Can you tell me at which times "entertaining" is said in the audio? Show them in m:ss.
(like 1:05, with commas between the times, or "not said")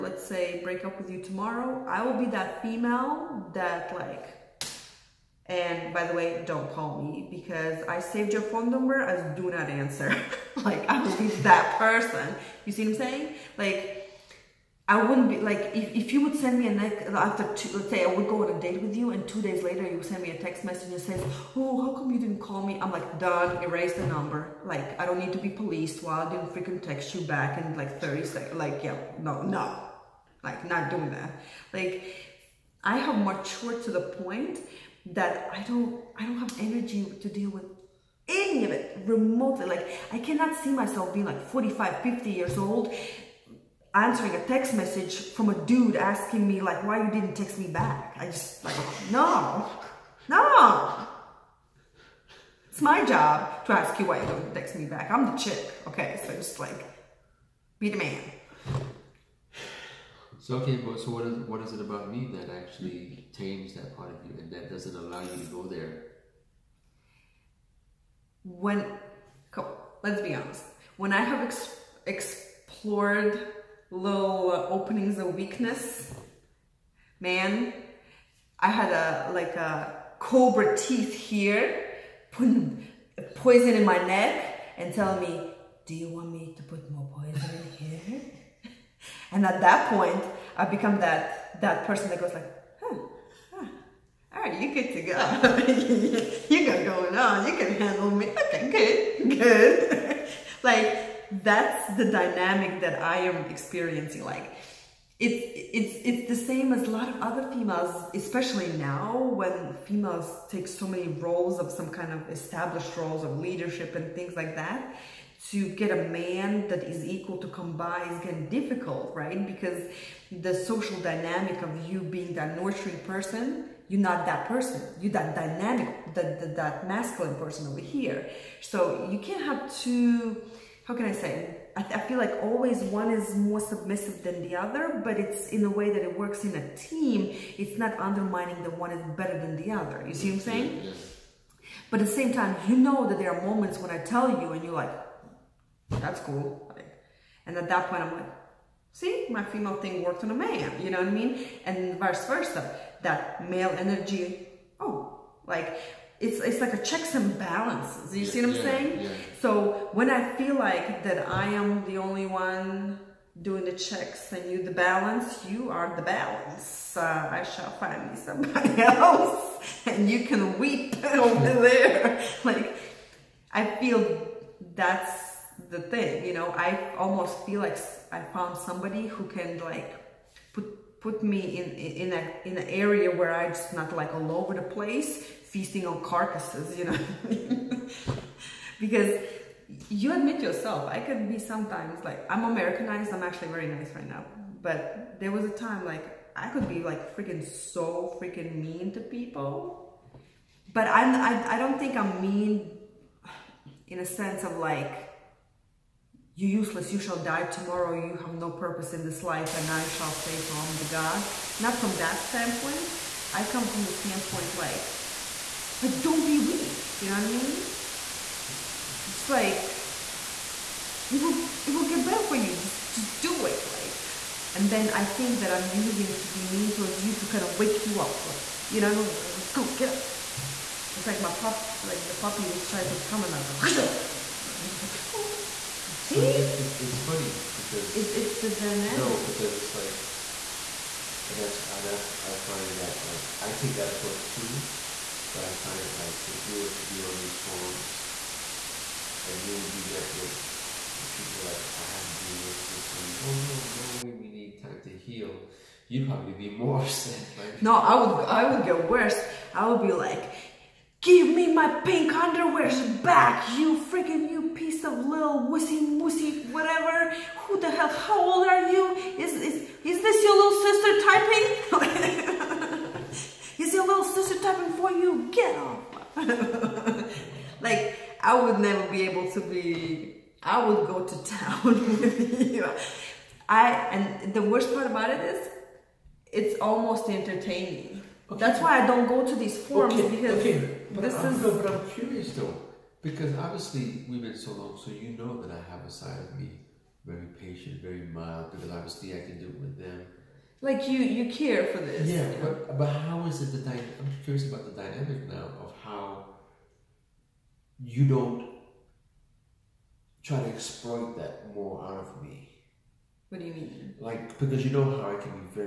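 4:47.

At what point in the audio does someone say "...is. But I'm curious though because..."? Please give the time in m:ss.
4:51.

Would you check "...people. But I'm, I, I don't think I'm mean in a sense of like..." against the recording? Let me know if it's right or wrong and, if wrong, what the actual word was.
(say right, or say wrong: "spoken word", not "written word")
right.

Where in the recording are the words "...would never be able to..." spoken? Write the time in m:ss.
4:38.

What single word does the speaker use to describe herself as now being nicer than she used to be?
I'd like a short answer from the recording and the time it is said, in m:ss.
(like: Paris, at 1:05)
Americanized, at 3:12.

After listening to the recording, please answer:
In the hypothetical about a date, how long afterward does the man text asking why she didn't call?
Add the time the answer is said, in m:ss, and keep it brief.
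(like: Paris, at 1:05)
two days, at 0:19.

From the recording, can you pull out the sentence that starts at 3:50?
It's like my pup, like the puppy was trying to come another.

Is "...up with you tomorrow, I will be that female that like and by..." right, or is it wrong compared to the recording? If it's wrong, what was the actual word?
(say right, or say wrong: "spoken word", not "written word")
right.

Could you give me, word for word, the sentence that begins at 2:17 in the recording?
It's not undermining the one is better than the other.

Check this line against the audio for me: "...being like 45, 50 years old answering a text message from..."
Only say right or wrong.
right.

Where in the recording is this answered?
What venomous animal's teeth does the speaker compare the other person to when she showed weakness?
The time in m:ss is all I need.
1:20.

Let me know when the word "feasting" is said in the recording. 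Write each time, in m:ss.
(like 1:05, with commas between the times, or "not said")
3:05.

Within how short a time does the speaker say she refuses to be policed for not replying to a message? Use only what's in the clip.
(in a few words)
30 seconds.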